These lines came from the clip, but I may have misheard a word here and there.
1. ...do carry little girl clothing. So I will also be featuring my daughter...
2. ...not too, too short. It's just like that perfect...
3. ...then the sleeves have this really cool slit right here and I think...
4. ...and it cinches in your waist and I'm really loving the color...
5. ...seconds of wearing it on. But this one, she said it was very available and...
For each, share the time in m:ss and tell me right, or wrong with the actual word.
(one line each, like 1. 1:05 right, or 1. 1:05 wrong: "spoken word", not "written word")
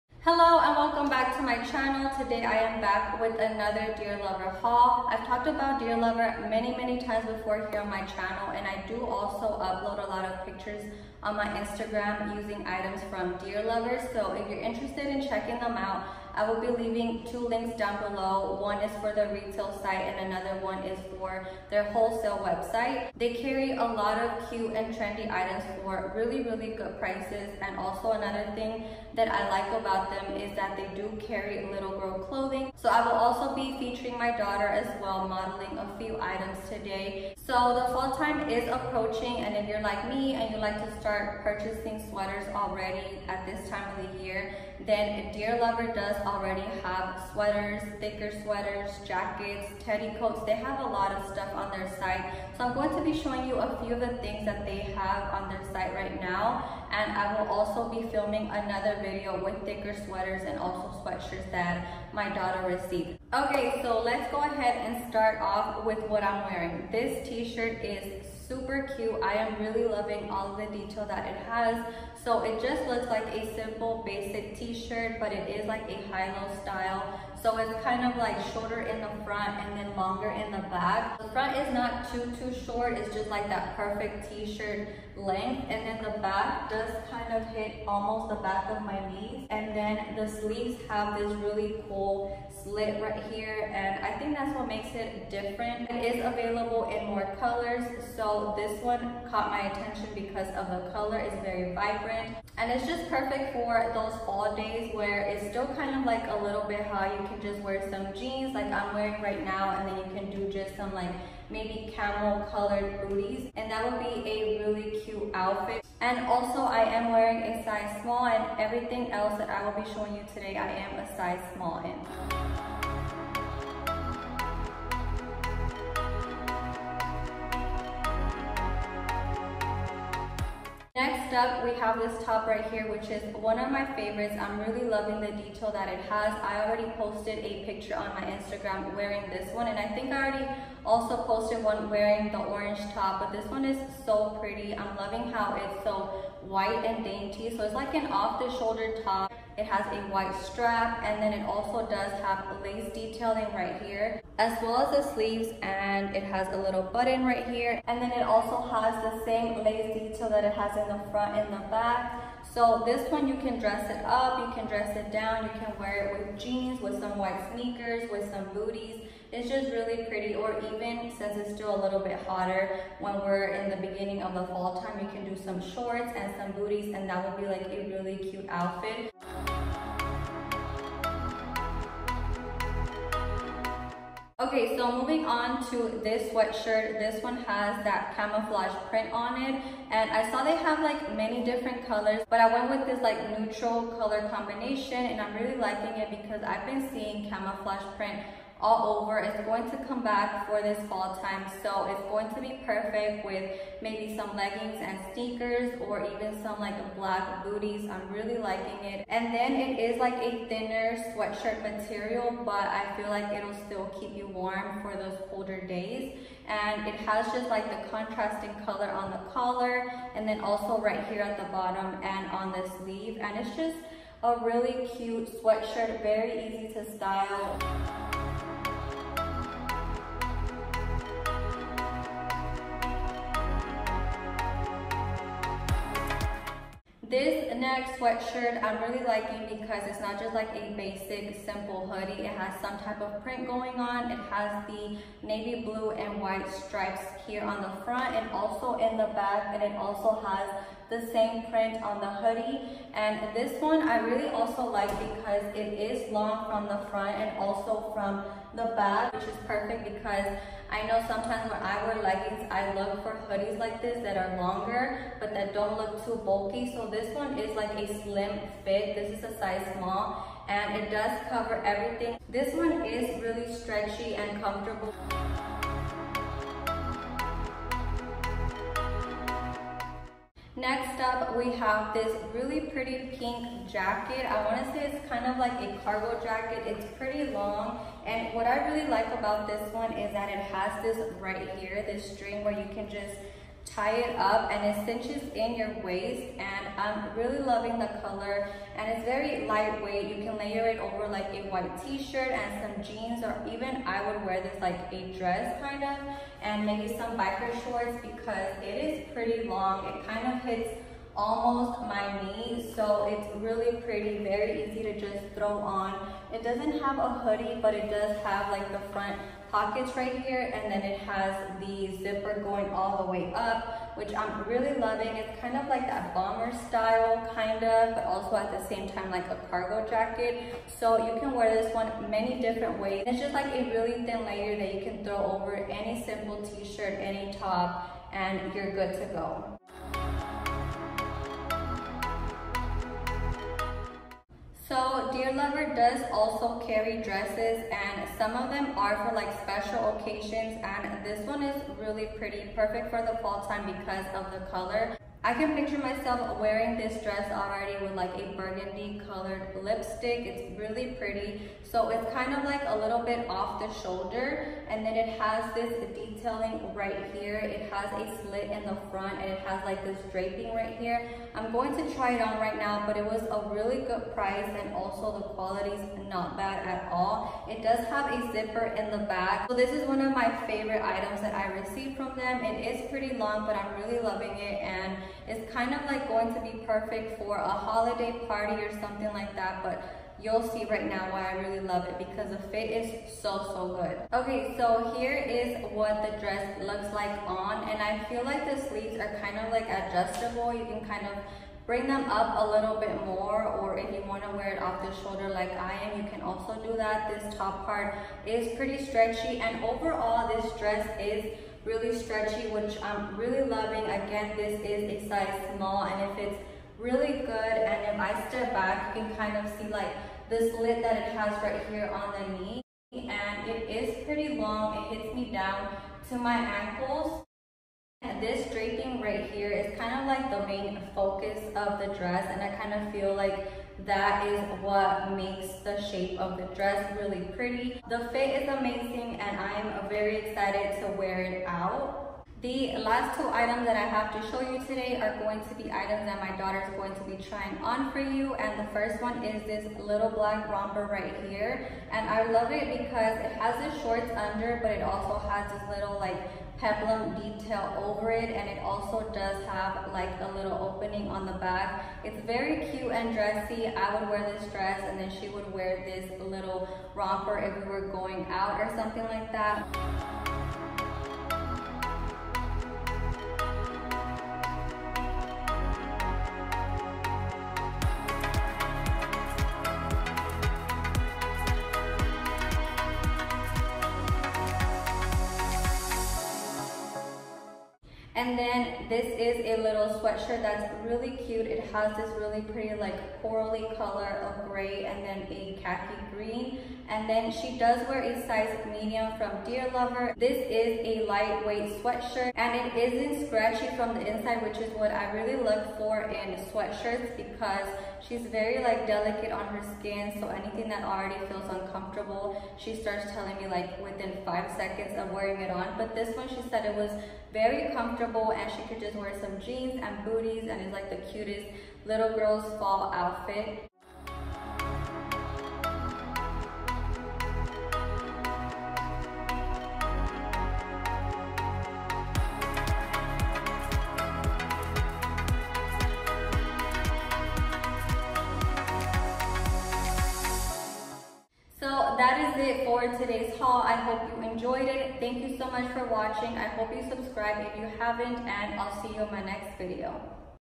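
1. 0:30 right
2. 1:21 right
3. 1:29 right
4. 4:54 right
5. 8:34 wrong: "comfortable", not "available".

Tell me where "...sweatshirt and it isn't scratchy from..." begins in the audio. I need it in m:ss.
8:21.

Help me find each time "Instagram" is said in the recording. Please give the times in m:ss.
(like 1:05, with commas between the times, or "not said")
0:11, 2:18.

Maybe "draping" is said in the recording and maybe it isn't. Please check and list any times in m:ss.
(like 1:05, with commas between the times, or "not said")
6:10, 7:08.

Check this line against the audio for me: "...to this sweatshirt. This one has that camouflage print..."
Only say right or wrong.
right.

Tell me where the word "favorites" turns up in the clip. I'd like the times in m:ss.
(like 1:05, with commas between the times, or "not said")
2:13, 6:20.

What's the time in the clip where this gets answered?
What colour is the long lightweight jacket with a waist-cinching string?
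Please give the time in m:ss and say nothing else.
4:43.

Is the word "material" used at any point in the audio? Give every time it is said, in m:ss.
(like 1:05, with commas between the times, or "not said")
3:31.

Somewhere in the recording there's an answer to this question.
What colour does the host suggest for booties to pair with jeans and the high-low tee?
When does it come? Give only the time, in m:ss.
1:51.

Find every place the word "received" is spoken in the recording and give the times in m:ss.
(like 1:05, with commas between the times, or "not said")
1:02, 6:21.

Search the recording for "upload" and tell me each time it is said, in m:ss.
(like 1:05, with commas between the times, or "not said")
0:09.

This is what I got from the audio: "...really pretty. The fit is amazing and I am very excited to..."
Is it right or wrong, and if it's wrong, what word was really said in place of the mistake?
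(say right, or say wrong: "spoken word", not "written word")
right.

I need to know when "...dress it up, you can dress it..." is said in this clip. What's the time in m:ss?
2:43.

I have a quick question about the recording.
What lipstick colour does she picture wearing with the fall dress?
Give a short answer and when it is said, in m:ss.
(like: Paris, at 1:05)
Burgundy, at 5:58.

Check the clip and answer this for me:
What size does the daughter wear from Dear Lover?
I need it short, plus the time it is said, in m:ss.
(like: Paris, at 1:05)
Medium, at 8:18.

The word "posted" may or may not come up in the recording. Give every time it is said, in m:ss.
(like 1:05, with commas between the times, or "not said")
2:16, 2:21.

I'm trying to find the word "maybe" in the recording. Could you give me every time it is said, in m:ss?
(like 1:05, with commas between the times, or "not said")
1:51, 3:23, 5:06.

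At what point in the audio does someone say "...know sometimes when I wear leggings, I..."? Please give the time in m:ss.
4:20.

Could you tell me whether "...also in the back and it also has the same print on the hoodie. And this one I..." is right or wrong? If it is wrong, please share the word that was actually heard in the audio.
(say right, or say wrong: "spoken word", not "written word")
right.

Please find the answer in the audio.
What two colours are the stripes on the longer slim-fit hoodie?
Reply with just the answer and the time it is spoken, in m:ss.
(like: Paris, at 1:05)
Navy blue and white, at 4:05.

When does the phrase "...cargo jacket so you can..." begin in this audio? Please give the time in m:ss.
5:29.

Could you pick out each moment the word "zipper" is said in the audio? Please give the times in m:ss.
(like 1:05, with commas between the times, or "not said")
5:21, 6:18.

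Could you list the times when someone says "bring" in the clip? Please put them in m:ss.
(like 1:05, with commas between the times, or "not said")
6:41.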